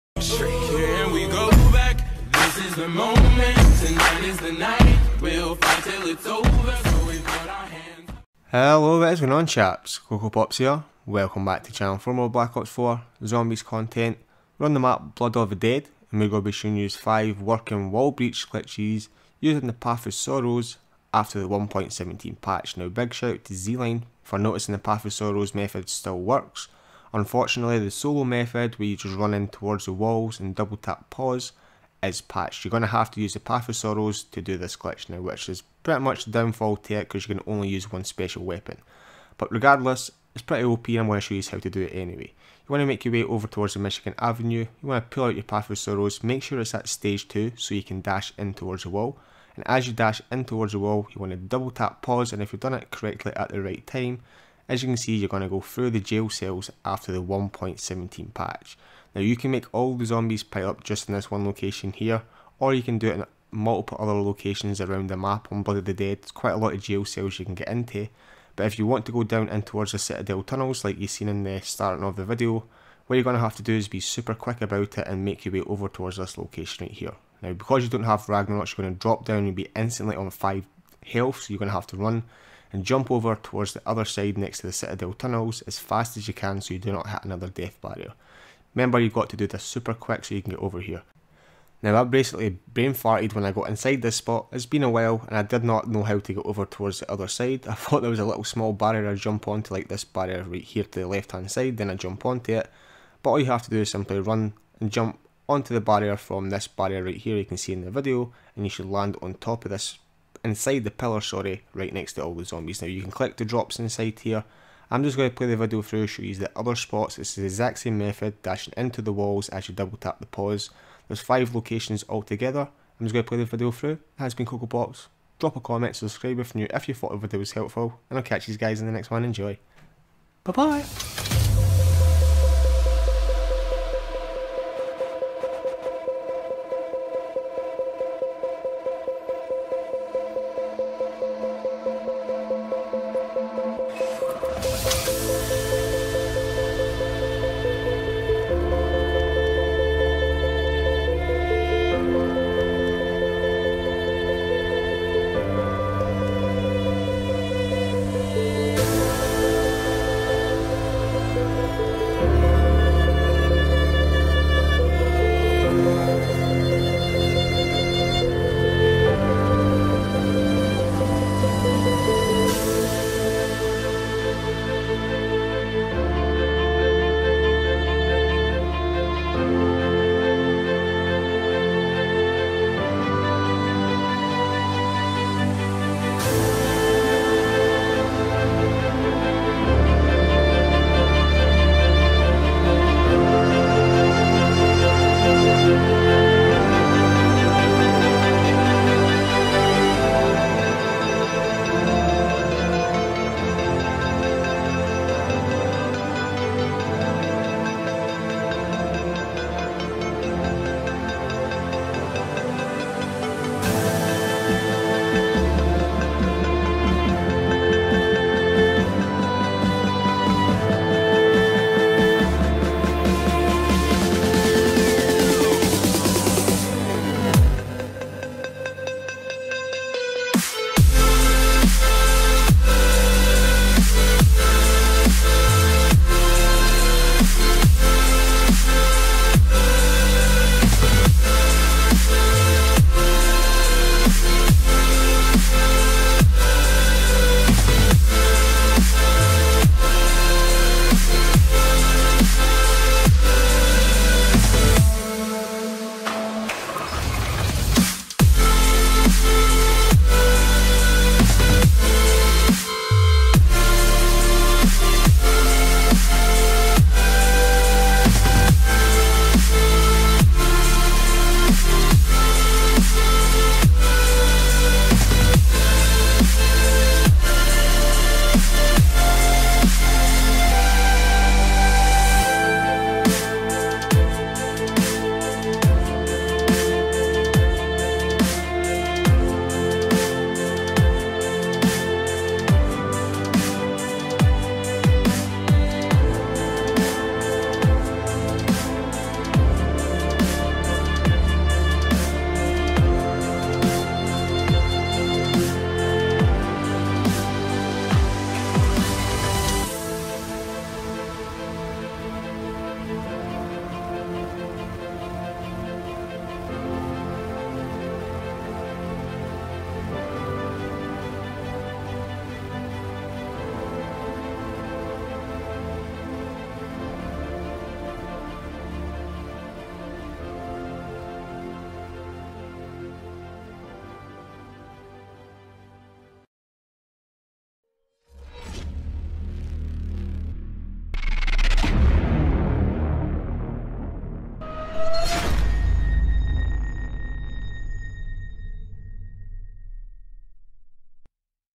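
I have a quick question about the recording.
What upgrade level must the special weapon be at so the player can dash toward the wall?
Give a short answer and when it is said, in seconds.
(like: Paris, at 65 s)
stage 2, at 46 s.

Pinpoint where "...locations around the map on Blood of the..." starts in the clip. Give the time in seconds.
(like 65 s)
64 s.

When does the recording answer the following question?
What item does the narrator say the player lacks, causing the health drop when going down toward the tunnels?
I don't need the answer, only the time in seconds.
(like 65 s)
78 s.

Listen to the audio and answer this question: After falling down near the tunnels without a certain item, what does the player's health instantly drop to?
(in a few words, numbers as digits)
5.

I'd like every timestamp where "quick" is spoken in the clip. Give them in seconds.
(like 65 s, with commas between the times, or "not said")
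74 s, 89 s.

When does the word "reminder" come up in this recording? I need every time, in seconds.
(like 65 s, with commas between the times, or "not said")
not said.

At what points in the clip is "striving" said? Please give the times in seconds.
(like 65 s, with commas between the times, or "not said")
not said.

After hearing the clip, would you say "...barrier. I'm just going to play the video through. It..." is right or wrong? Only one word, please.
wrong.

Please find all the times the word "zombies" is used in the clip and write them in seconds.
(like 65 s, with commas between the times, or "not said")
13 s, 60 s, 112 s.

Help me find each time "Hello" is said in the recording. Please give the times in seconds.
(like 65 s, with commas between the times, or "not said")
8 s.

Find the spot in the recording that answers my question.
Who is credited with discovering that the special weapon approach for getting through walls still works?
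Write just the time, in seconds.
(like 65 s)
23 s.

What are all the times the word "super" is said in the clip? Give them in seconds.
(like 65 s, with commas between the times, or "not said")
73 s, 89 s.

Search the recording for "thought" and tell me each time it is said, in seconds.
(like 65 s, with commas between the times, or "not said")
97 s, 126 s.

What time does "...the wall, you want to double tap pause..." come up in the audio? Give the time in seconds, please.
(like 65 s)
50 s.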